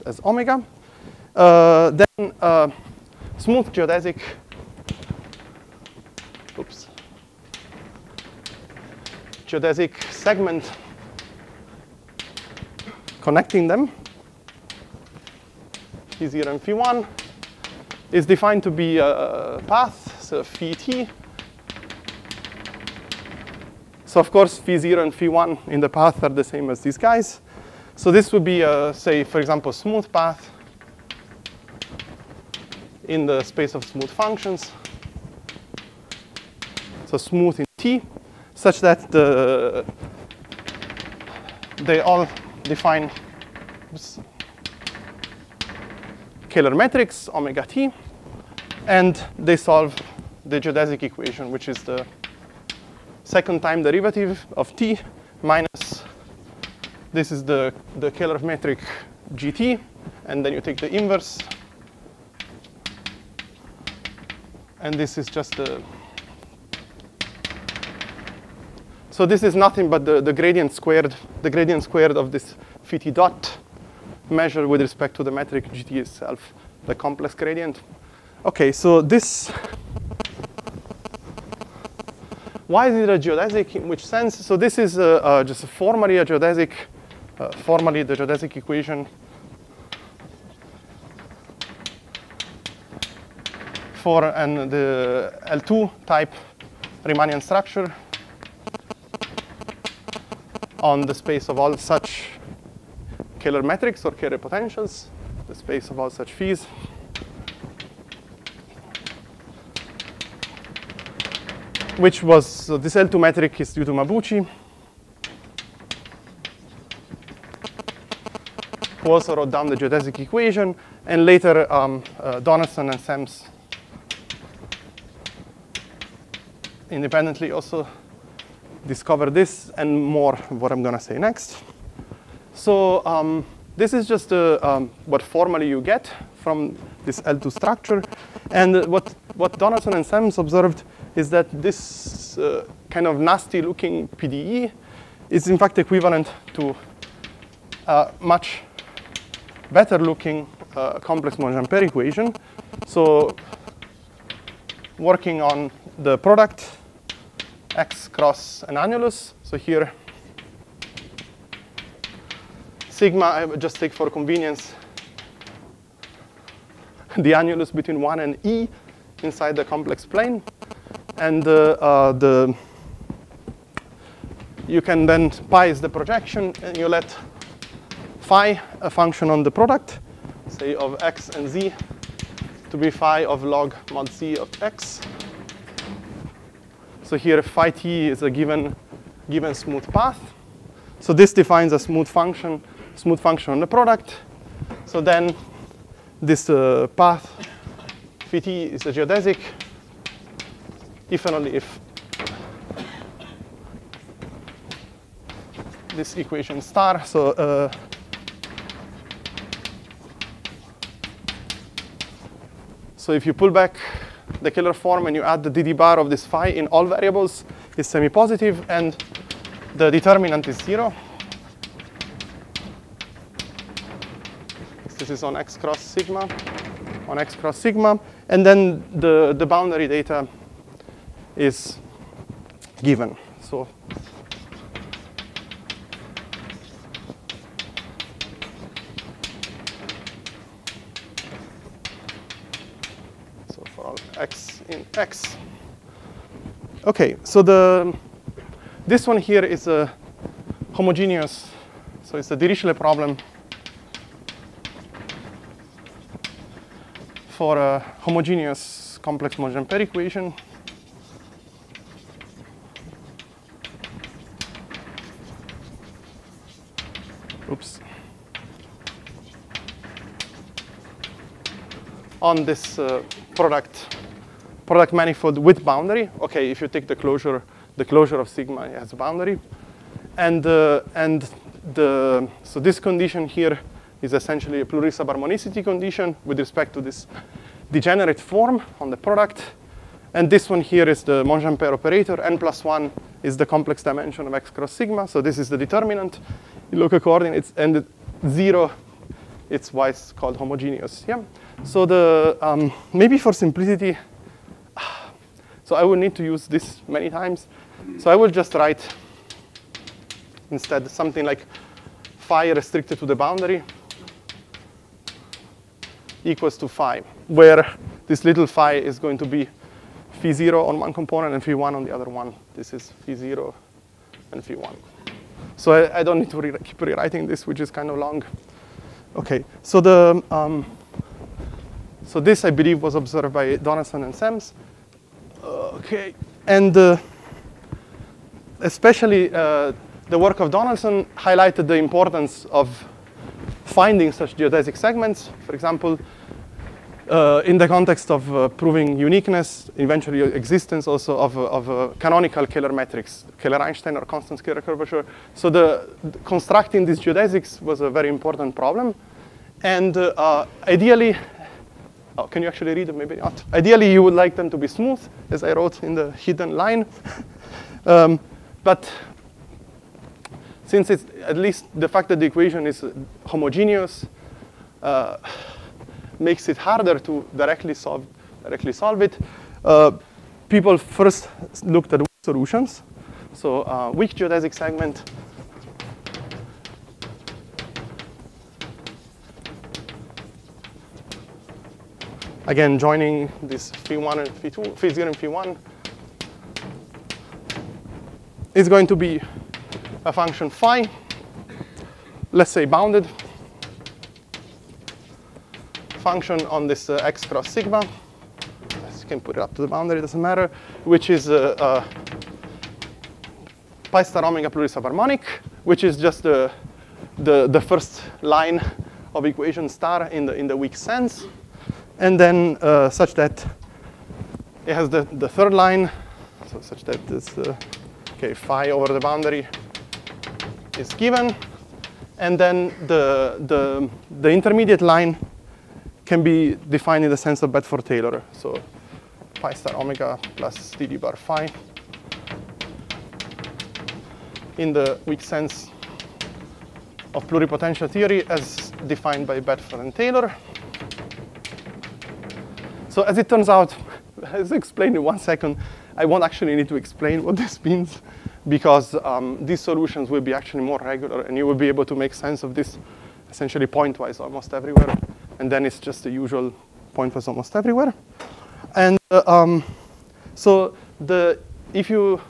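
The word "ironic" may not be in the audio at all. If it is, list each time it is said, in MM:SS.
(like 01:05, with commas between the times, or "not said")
not said.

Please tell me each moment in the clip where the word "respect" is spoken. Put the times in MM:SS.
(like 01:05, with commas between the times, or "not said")
01:14, 04:46.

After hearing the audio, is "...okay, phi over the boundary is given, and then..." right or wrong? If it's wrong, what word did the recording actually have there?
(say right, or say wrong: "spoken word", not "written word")
right.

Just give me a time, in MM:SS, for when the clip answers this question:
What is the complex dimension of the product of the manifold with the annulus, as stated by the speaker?
04:52.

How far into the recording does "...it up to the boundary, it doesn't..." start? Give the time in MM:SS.
06:49.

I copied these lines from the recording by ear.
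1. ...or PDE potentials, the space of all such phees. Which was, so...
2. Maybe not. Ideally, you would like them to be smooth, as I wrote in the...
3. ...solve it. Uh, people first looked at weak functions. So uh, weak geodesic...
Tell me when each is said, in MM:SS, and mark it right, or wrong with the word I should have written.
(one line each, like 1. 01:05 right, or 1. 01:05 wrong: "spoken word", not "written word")
1. 01:44 wrong: "Kähler", not "PDE"
2. 06:02 right
3. 06:18 wrong: "solutions", not "functions".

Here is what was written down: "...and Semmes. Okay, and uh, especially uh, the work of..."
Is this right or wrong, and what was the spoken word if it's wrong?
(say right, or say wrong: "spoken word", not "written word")
right.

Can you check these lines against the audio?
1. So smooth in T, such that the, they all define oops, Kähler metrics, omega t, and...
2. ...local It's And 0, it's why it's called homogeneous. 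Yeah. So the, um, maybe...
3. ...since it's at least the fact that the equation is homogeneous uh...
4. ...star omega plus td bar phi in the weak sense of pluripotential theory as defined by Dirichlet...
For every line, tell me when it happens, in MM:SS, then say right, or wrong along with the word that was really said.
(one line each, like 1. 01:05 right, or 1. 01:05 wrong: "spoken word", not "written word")
1. 00:37 right
2. 04:56 right
3. 06:10 right
4. 07:19 wrong: "Bedford", not "Dirichlet".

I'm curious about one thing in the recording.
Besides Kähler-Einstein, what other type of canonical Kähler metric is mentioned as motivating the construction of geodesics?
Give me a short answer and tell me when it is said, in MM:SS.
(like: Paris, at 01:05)
constant Kähler curvature, at 05:54.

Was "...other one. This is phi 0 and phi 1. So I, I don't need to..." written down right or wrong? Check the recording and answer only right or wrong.
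right.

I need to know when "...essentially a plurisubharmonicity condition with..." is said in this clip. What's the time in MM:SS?
04:44.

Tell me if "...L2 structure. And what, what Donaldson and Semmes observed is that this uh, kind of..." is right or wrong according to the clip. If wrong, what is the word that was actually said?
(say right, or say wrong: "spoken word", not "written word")
right.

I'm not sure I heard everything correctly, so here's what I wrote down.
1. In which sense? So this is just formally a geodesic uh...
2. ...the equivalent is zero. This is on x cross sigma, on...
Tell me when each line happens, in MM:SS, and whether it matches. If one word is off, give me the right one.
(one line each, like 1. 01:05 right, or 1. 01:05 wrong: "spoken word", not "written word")
1. 01:23 right
2. 03:39 wrong: "determinant", not "equivalent".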